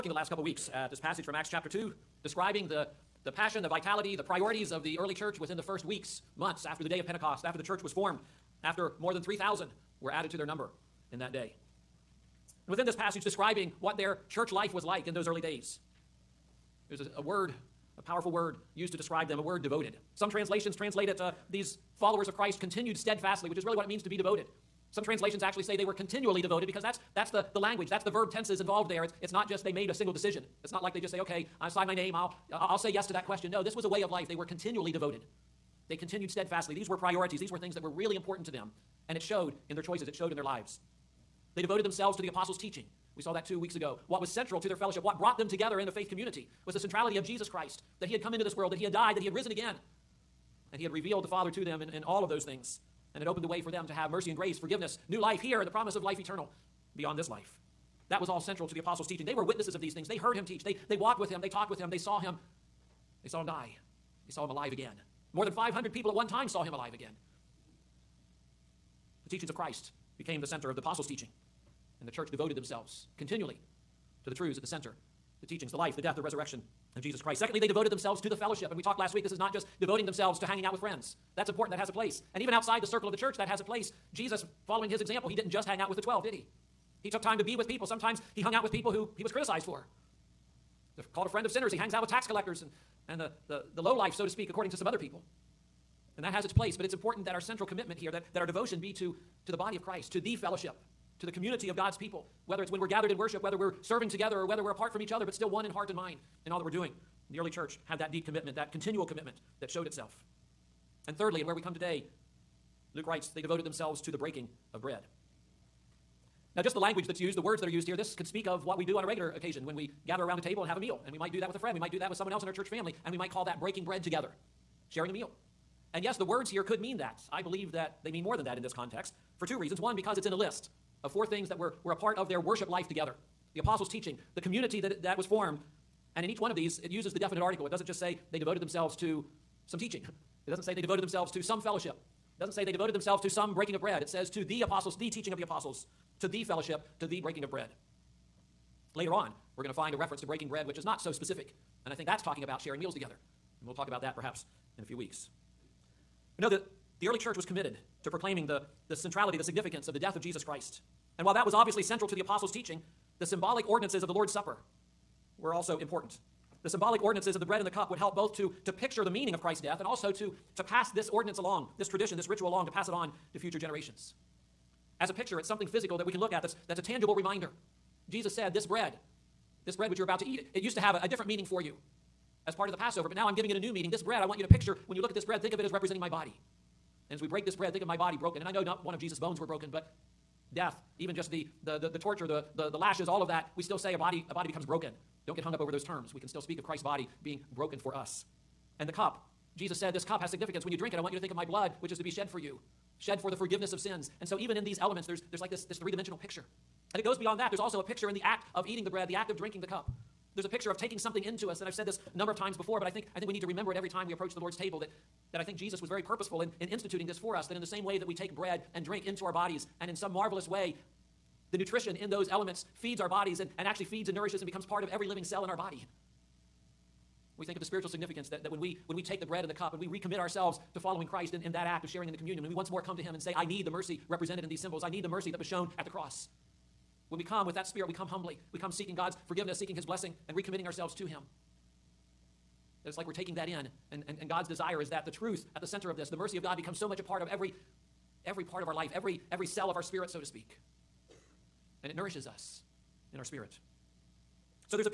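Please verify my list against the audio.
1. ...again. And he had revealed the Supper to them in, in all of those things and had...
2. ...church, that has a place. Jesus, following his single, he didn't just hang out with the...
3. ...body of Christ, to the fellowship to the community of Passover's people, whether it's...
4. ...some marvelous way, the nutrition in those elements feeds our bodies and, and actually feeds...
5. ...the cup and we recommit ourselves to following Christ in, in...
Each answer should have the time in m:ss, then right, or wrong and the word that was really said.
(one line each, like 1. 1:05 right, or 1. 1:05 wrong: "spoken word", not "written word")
1. 0:49 wrong: "Father", not "Supper"
2. 1:23 wrong: "example", not "single"
3. 1:39 wrong: "God", not "Passover"
4. 3:39 right
5. 3:49 right.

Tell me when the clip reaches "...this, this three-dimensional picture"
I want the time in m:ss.
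3:25.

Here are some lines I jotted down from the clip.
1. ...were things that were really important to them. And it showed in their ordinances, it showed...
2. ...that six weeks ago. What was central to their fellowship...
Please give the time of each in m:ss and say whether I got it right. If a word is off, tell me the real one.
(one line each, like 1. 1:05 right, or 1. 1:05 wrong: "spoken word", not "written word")
1. 0:37 wrong: "choices", not "ordinances"
2. 0:43 wrong: "two", not "six".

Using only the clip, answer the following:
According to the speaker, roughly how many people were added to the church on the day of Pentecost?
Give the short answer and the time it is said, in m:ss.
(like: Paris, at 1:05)
more than 3,000, at 0:08.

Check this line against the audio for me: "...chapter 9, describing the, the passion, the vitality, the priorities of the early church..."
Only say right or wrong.
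wrong.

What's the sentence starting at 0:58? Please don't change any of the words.
That was all central to the apostles' teaching.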